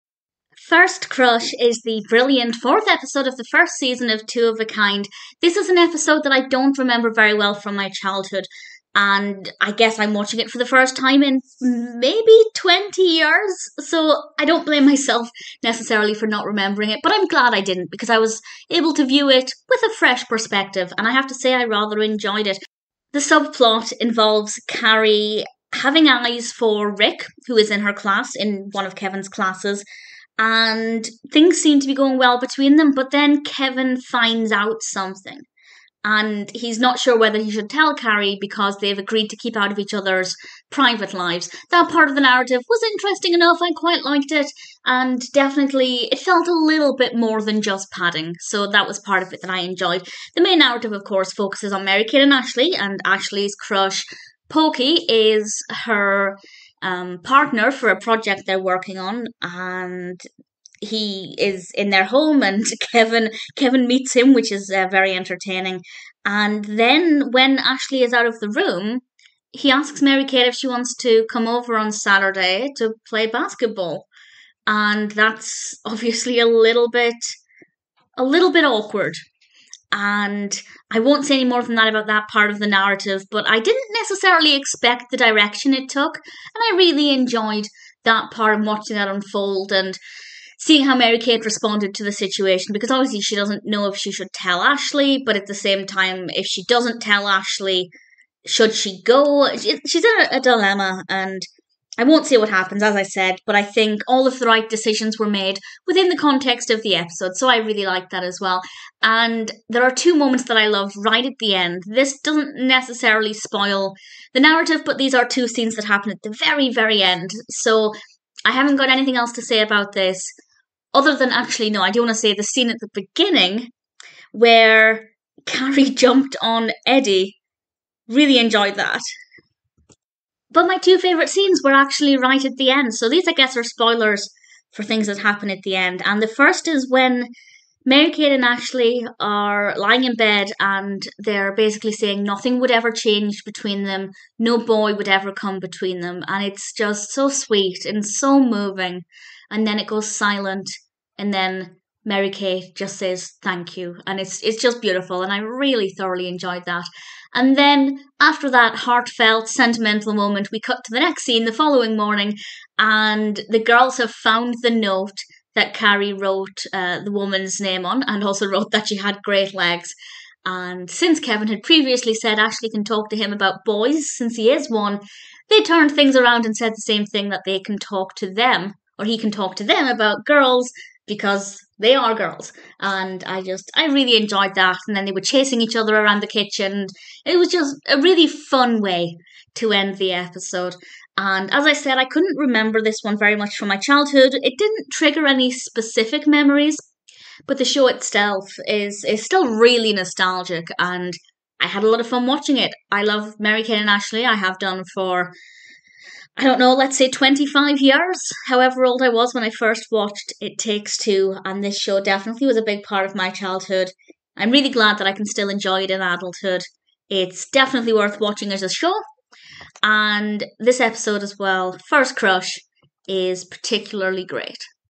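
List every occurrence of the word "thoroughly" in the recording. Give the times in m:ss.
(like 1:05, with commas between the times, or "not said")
2:35.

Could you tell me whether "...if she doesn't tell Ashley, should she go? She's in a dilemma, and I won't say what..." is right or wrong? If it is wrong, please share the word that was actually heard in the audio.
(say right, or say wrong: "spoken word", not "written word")
right.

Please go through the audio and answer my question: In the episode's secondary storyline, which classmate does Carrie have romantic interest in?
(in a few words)
Rick.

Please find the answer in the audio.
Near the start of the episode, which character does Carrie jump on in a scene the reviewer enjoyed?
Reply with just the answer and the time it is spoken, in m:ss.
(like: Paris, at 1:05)
Eddie, at 2:06.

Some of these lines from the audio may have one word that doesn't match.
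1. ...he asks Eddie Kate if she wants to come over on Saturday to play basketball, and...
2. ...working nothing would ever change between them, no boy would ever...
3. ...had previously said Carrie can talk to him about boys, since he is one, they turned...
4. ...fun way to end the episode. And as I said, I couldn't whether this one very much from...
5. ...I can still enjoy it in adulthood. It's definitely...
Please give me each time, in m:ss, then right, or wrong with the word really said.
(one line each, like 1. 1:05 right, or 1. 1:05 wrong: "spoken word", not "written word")
1. 1:09 wrong: "Mary", not "Eddie"
2. 2:21 wrong: "saying", not "working"
3. 2:51 wrong: "Ashley", not "Carrie"
4. 3:08 wrong: "remember", not "whether"
5. 3:35 right.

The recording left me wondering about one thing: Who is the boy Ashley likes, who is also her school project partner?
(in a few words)
Pokey.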